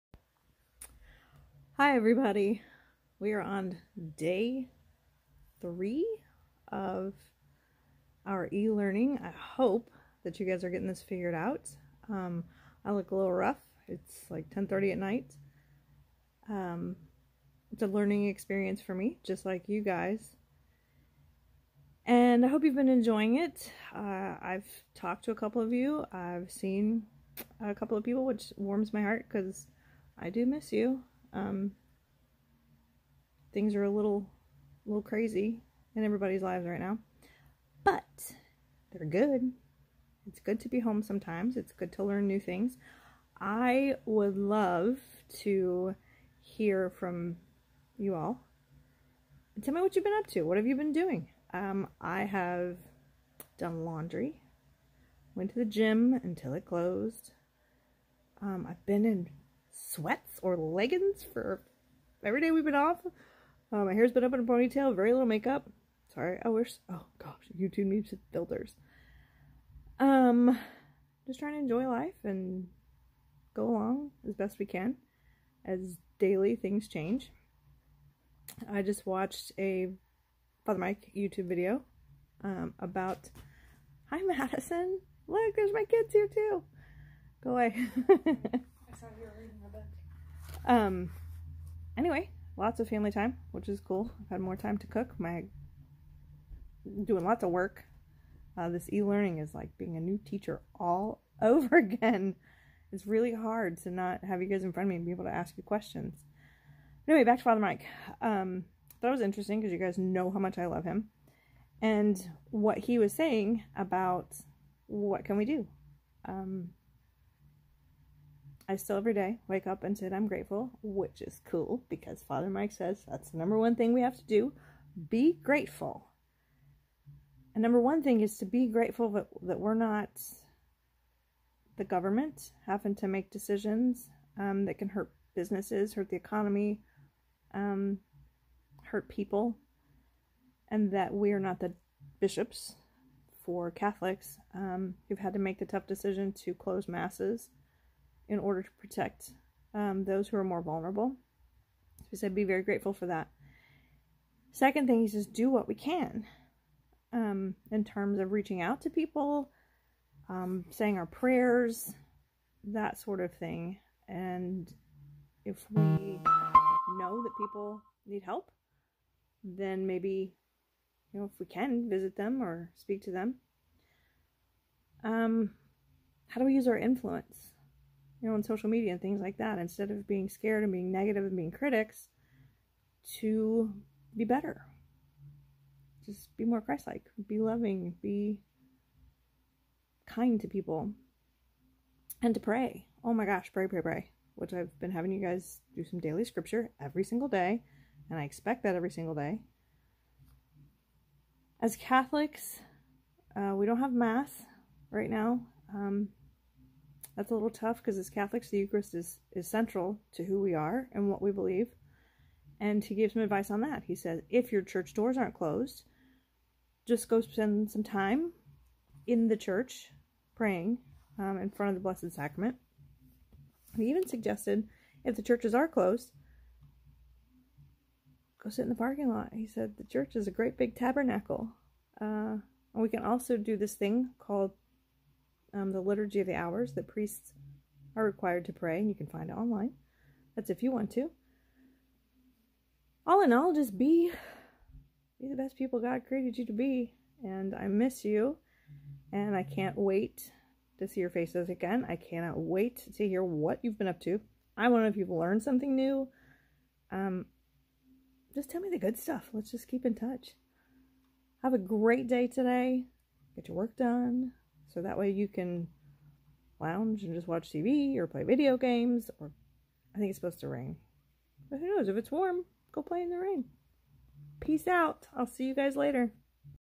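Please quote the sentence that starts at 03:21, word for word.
As Catholics, uh, we don't have Mass right now.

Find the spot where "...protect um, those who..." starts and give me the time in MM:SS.
02:28.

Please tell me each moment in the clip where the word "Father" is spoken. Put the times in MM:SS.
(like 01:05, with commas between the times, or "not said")
01:20, 01:47, 02:02.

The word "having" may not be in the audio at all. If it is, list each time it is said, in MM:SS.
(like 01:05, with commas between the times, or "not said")
02:12, 03:14.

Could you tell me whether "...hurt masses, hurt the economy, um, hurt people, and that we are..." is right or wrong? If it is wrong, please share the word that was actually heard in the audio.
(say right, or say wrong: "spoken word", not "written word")
wrong: "businesses", not "masses".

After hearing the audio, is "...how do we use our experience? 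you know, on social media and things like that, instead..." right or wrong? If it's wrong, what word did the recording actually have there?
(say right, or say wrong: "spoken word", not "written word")
wrong: "influence", not "experience".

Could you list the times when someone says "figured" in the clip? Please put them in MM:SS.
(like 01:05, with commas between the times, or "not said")
00:11.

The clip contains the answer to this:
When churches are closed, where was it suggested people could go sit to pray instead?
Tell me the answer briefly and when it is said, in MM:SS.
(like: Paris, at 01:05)
The parking lot, at 03:48.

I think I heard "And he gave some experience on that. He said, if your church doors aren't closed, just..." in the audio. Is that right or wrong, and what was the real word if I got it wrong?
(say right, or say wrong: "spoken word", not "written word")
wrong: "advice", not "experience".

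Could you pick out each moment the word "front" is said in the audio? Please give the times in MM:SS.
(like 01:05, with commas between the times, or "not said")
01:44, 03:41.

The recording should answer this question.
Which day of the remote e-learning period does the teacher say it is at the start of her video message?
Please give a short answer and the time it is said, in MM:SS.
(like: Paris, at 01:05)
Day three, at 00:04.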